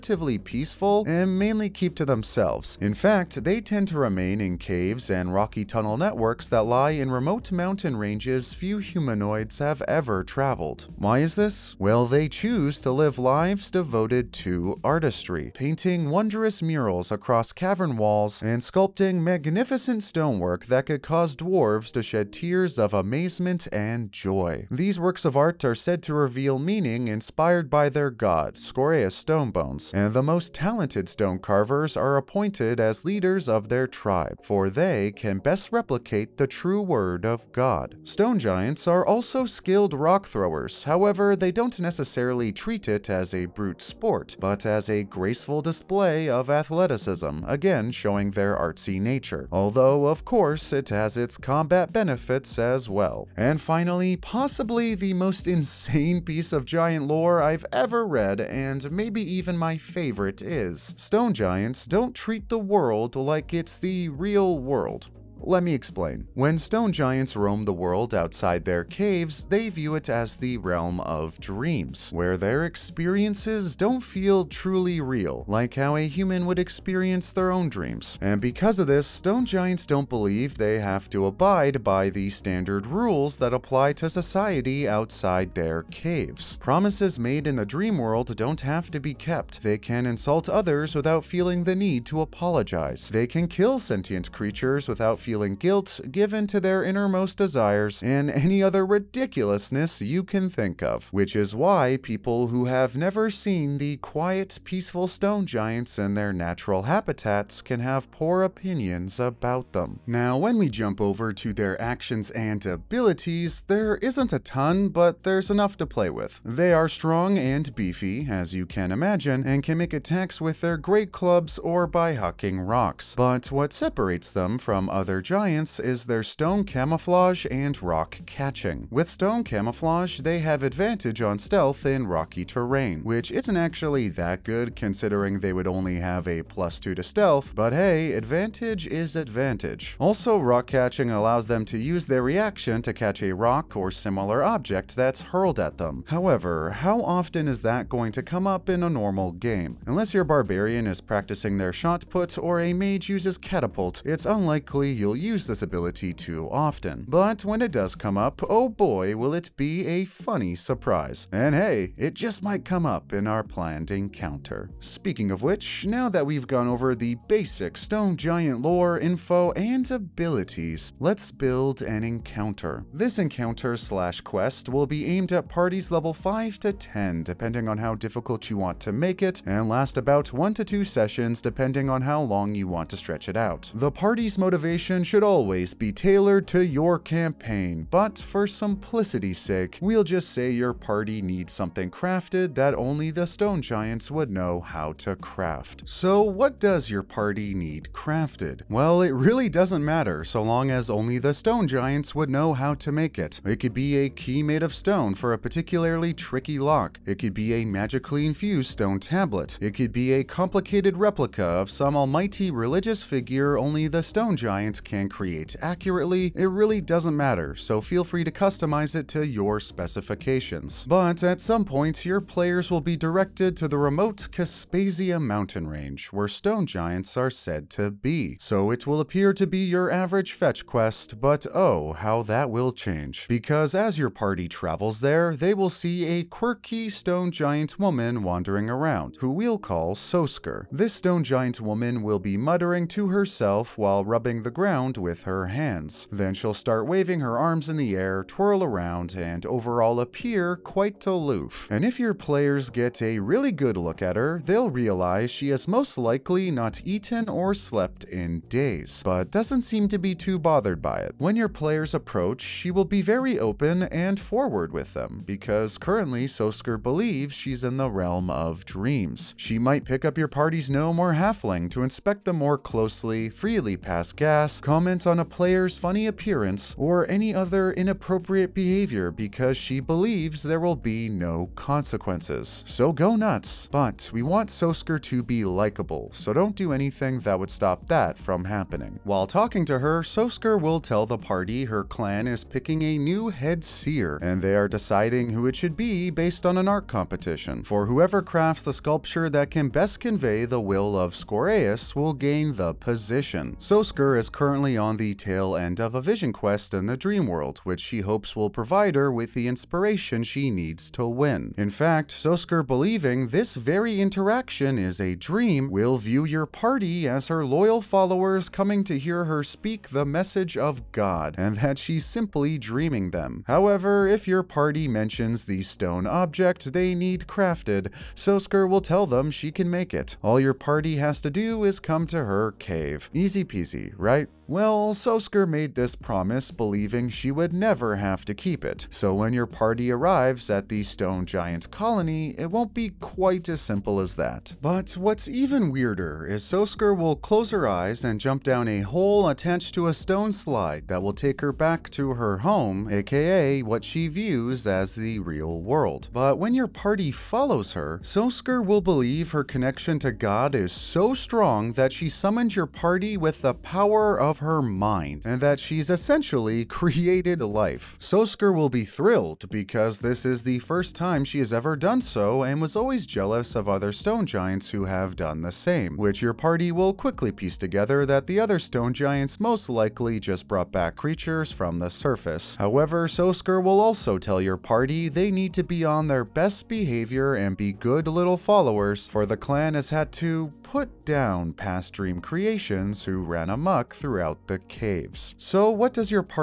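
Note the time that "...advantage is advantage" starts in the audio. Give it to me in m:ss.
2:18.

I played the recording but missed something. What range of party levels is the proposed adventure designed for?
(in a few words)
5 to 10.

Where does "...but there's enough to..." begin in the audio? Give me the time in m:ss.
1:54.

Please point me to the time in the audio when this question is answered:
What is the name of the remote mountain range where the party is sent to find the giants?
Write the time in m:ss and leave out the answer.
3:44.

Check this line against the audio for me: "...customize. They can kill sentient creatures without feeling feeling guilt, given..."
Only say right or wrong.
wrong.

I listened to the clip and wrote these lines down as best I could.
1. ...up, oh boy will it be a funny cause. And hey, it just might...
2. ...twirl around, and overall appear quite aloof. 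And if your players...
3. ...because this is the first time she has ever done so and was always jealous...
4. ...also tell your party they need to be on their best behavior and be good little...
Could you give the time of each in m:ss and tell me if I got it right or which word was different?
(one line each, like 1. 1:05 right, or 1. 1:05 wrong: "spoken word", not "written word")
1. 2:38 wrong: "surprise", not "cause"
2. 4:08 right
3. 6:09 right
4. 6:23 right.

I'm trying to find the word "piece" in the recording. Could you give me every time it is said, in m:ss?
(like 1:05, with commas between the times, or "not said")
0:56, 6:17.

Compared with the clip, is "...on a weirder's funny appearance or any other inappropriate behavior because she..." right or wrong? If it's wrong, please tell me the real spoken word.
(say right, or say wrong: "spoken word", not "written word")
wrong: "player", not "weirder".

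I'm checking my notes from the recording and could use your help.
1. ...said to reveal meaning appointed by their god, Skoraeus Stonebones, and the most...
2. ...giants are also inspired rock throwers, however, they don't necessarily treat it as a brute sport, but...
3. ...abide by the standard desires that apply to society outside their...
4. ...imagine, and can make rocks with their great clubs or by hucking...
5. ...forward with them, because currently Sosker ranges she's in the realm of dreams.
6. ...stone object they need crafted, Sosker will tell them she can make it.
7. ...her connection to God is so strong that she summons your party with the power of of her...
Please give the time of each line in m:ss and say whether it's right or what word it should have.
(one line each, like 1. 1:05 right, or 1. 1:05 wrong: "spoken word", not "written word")
1. 0:25 wrong: "inspired", not "appointed"
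2. 0:38 wrong: "skilled", not "inspired"
3. 1:21 wrong: "rules", not "desires"
4. 1:58 wrong: "attacks", not "rocks"
5. 4:24 wrong: "believes", not "ranges"
6. 5:25 right
7. 5:59 right.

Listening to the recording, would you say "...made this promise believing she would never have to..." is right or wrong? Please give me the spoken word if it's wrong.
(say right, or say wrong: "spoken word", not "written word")
right.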